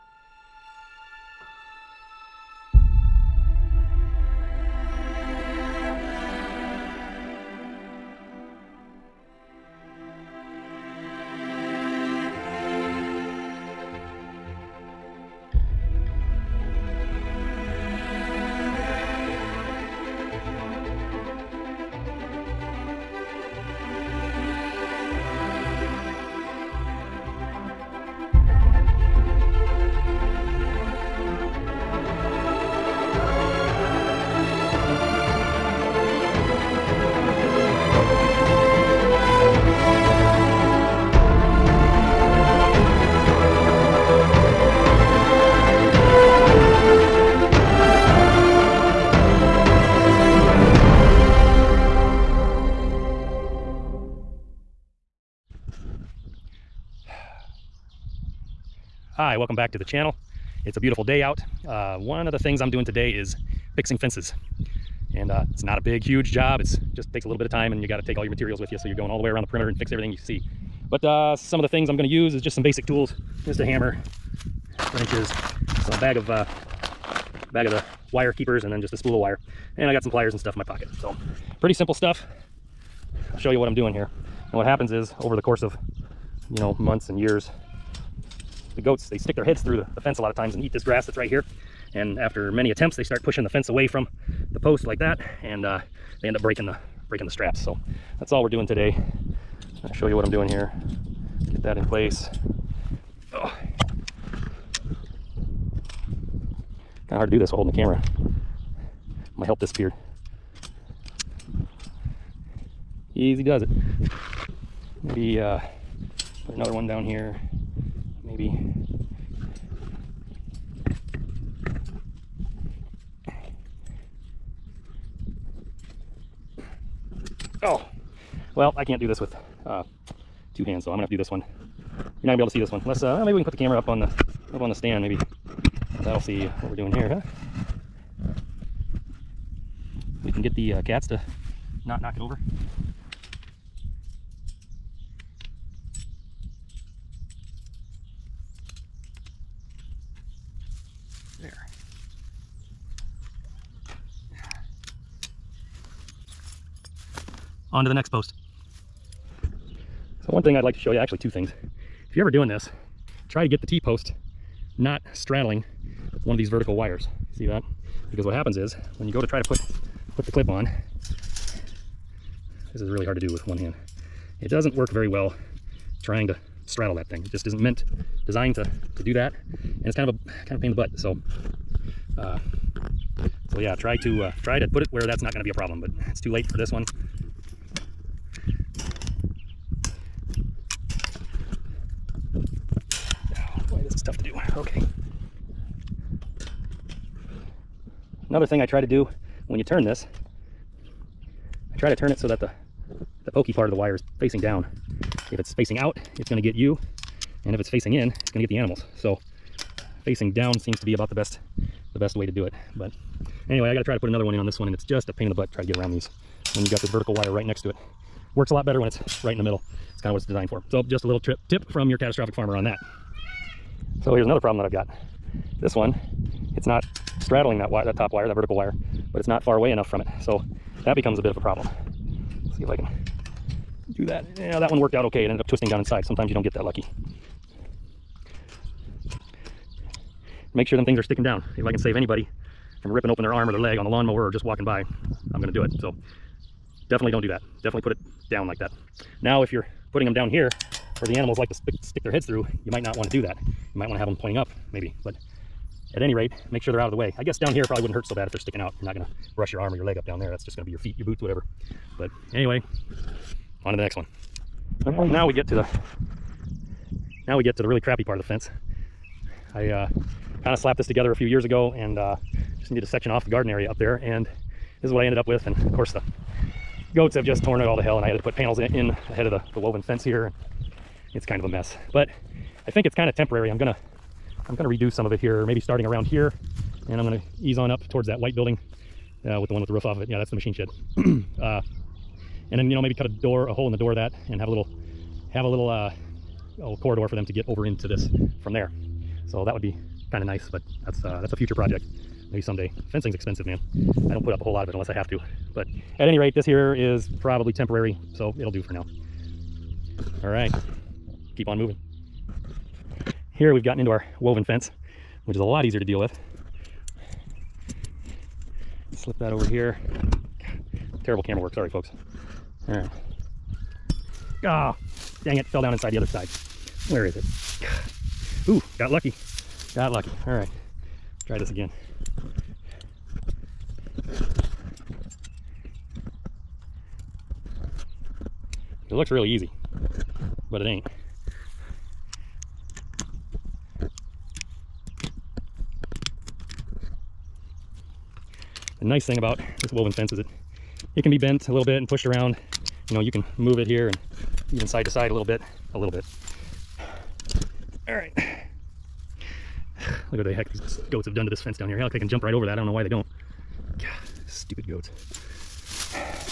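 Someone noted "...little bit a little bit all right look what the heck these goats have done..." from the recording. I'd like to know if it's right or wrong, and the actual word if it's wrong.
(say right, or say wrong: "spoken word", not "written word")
right.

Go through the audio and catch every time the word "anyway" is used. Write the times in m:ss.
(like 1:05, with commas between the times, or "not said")
3:33, 4:22.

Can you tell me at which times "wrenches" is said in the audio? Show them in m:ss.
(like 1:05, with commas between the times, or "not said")
1:14.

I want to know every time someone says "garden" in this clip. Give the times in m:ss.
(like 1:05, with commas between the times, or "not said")
4:33.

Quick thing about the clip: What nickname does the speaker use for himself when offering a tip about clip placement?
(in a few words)
catastrophic farmer.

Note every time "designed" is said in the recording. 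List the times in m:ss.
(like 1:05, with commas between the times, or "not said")
2:58, 3:40.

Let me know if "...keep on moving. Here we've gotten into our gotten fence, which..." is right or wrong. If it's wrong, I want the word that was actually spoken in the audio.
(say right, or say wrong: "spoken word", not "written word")
wrong: "woven", not "gotten".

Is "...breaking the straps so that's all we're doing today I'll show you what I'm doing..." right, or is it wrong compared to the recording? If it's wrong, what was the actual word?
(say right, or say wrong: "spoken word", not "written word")
right.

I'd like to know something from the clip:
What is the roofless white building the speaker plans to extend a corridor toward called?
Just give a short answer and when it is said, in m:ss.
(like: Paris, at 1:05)
machine shed, at 4:50.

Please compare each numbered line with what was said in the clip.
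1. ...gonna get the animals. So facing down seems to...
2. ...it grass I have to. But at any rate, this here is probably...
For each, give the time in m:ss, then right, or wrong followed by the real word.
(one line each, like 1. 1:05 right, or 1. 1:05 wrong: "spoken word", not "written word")
1. 3:28 right
2. 5:04 wrong: "unless", not "grass".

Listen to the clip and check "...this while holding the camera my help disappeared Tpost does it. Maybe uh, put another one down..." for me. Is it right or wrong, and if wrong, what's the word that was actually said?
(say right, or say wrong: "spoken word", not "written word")
wrong: "Easy", not "Tpost".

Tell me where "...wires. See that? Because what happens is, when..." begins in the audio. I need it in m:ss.
2:46.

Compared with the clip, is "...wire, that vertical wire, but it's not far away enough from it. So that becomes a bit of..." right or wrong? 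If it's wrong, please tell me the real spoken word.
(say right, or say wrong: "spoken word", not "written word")
right.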